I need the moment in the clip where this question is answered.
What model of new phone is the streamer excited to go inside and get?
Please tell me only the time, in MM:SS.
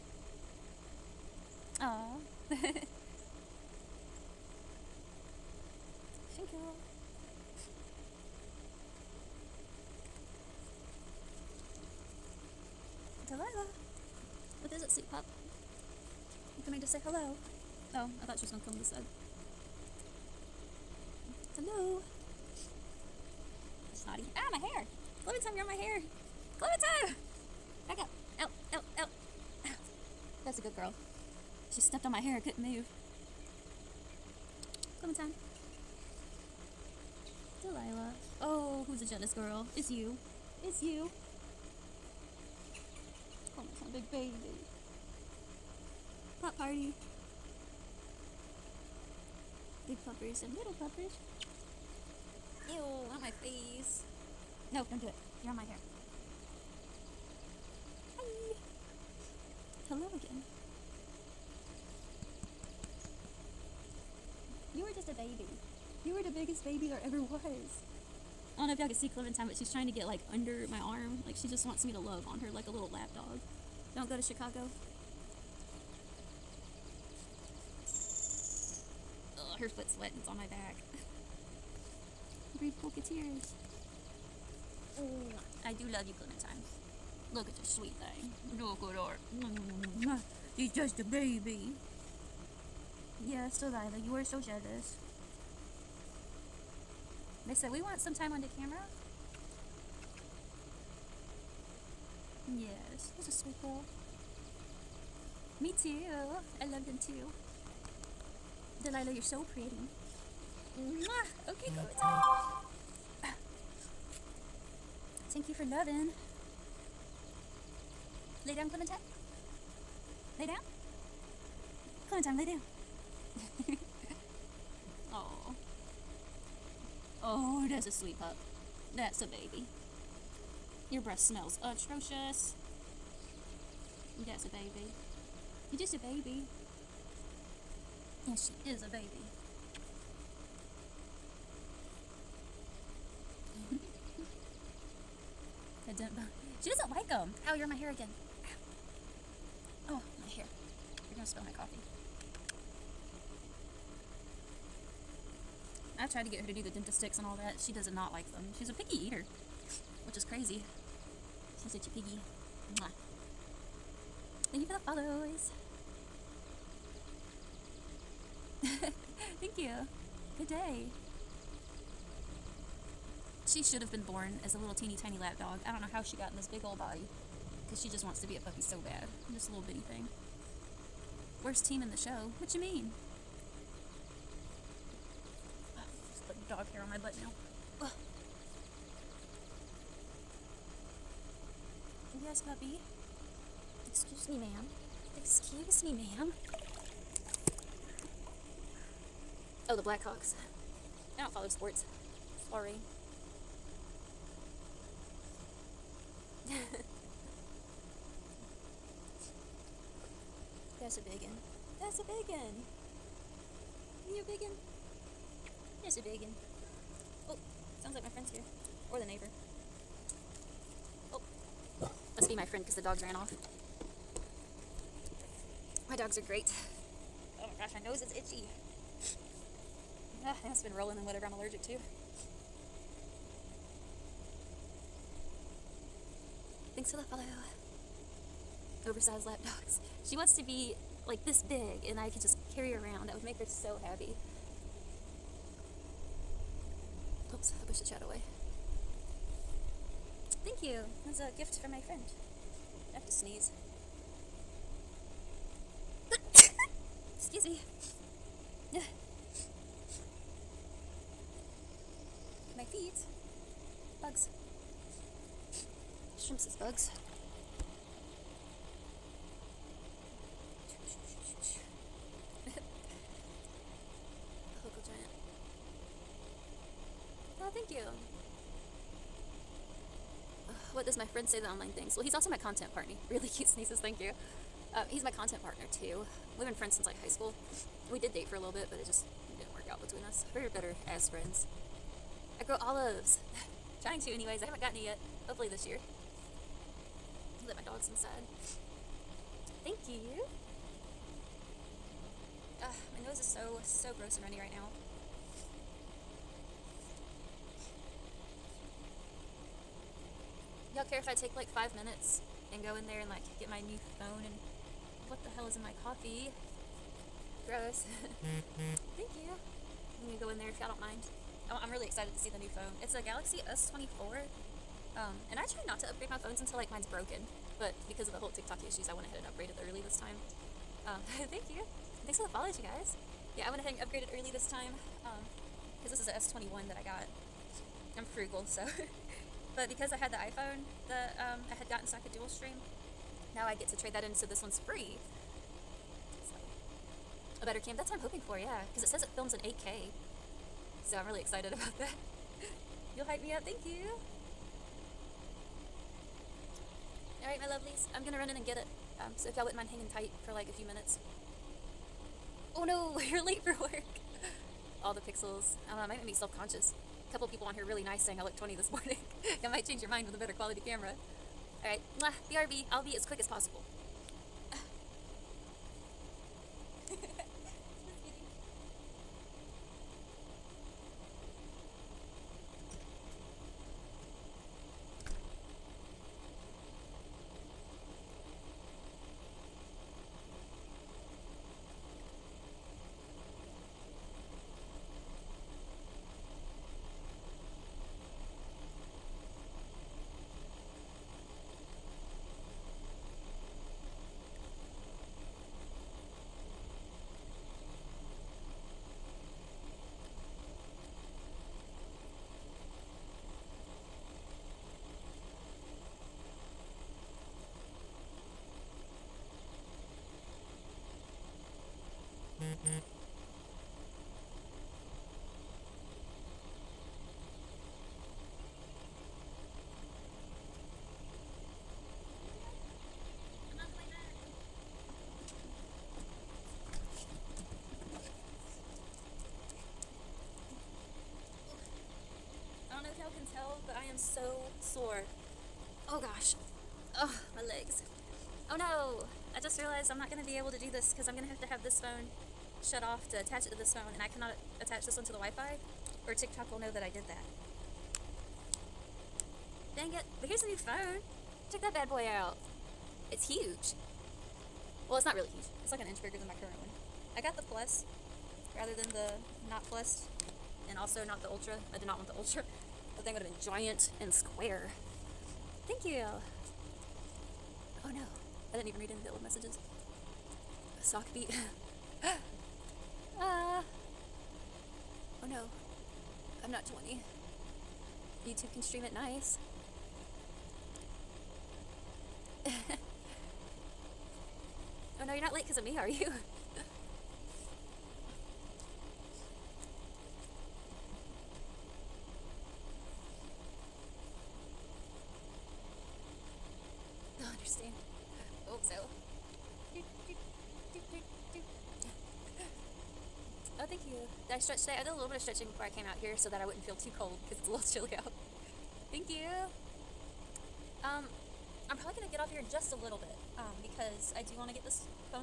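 05:22.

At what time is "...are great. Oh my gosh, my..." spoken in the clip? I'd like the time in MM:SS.
03:46.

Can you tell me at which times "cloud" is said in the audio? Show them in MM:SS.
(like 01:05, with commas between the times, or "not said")
not said.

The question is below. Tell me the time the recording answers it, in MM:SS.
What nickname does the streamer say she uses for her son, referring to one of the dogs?
00:43.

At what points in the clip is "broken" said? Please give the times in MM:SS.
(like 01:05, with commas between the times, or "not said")
05:26.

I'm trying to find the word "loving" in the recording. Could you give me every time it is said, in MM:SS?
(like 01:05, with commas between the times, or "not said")
01:55.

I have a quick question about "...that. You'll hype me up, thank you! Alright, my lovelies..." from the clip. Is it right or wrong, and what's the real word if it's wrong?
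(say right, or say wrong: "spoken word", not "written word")
right.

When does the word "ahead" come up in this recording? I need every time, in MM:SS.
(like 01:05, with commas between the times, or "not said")
05:29, 05:33.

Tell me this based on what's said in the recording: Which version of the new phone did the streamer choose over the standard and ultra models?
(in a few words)
the plus.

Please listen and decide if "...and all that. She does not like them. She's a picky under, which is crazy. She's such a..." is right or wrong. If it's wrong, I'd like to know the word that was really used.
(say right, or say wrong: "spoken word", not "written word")
wrong: "eater", not "under".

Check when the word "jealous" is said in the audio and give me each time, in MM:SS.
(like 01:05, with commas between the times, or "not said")
00:39, 01:34.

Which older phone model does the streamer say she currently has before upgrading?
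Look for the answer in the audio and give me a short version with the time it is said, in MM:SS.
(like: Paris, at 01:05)
S21, at 05:36.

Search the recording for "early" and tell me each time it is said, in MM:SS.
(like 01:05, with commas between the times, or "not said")
05:29, 05:34.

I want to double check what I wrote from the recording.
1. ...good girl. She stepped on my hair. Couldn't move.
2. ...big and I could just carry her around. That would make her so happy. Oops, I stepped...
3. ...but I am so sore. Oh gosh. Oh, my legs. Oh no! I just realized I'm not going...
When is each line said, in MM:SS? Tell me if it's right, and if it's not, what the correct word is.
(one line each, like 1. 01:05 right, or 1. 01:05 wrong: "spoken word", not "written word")
1. 00:30 right
2. 04:01 wrong: "pushed", not "stepped"
3. 07:23 right.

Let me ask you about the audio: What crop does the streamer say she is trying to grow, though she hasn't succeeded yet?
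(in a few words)
olives.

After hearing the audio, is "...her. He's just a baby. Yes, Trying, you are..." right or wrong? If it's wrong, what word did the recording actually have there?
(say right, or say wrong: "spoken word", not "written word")
wrong: "Delilah", not "Trying".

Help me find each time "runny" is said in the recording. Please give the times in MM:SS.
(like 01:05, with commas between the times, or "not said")
05:04.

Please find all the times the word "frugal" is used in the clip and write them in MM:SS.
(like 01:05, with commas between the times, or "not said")
05:38.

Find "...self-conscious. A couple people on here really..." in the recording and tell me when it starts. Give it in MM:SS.
06:06.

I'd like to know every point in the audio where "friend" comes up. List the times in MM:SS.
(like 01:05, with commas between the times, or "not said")
03:38, 03:42, 04:11, 04:41, 04:46, 04:51.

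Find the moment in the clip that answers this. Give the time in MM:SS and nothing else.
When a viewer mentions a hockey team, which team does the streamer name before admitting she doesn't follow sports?
03:19.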